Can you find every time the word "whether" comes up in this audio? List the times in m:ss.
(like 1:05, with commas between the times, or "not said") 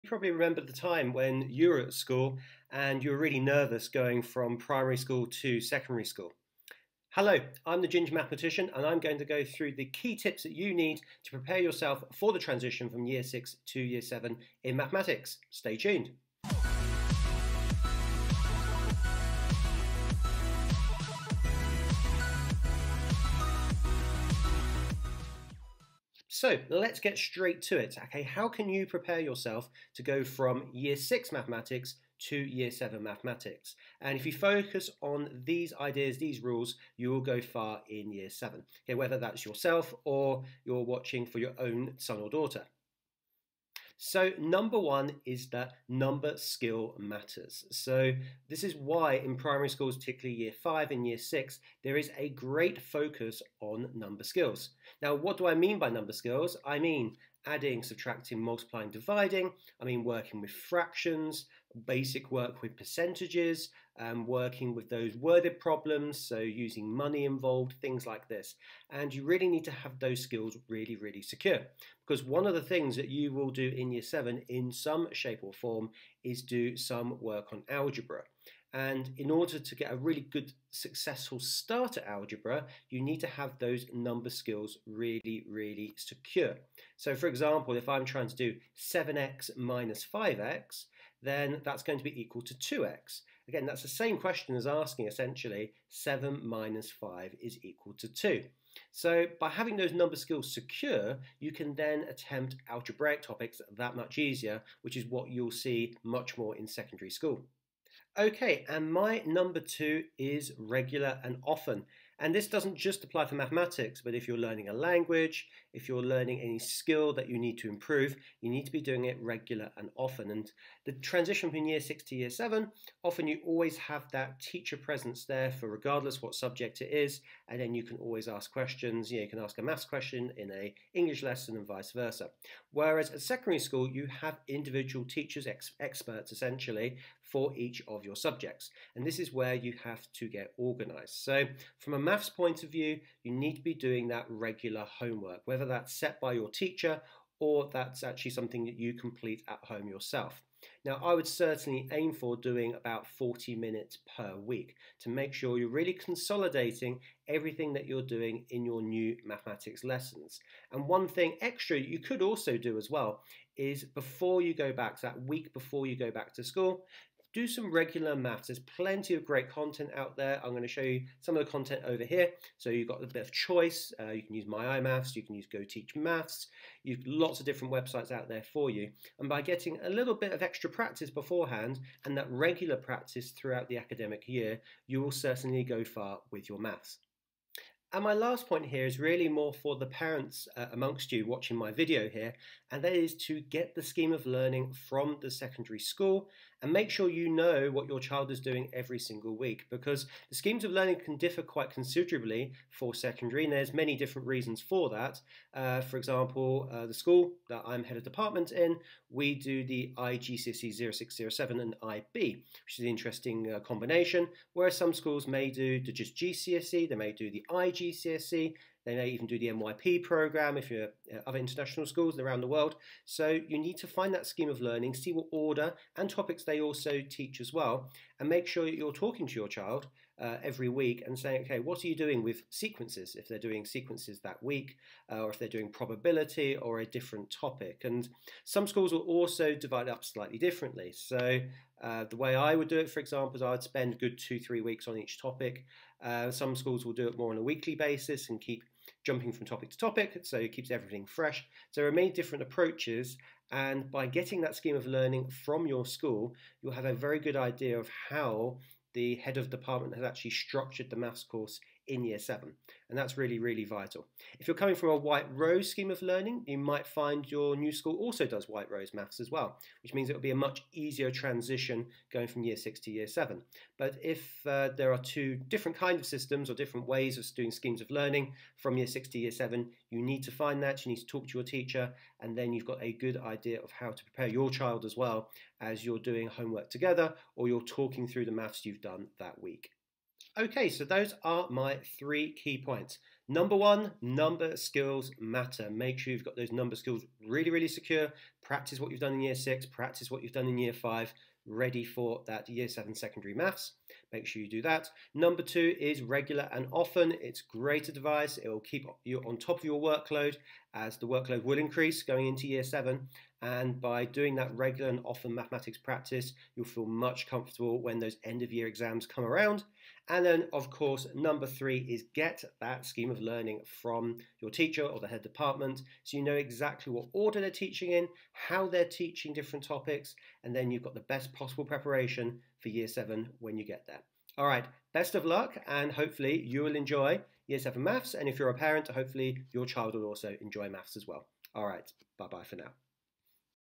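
0:38, 2:25.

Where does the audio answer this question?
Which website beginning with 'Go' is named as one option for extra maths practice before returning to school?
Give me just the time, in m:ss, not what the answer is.
2:55.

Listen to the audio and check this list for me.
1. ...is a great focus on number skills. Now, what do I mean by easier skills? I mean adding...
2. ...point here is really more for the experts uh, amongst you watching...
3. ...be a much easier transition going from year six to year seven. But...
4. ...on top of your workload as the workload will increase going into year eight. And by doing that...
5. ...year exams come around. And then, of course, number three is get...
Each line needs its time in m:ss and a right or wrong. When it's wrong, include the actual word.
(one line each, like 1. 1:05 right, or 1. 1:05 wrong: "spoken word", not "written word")
1. 0:51 wrong: "number", not "easier"
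2. 3:08 wrong: "parents", not "experts"
3. 4:30 right
4. 5:09 wrong: "seven", not "eight"
5. 5:18 right.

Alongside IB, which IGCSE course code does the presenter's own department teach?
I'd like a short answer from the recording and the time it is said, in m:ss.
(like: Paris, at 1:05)
0607, at 3:30.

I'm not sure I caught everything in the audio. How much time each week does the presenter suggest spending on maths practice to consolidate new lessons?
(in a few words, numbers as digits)
40 minutes.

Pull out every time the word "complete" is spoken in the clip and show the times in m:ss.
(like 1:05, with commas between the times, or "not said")
2:28.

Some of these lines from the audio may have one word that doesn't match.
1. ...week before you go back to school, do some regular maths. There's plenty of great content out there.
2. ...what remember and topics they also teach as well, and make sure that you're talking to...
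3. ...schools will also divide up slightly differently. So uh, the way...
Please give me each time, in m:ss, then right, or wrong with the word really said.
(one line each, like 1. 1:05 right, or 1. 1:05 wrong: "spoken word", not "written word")
1. 2:45 right
2. 3:45 wrong: "order", not "remember"
3. 3:58 right.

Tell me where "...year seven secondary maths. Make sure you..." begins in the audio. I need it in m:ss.
5:02.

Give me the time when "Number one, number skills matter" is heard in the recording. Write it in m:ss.
4:53.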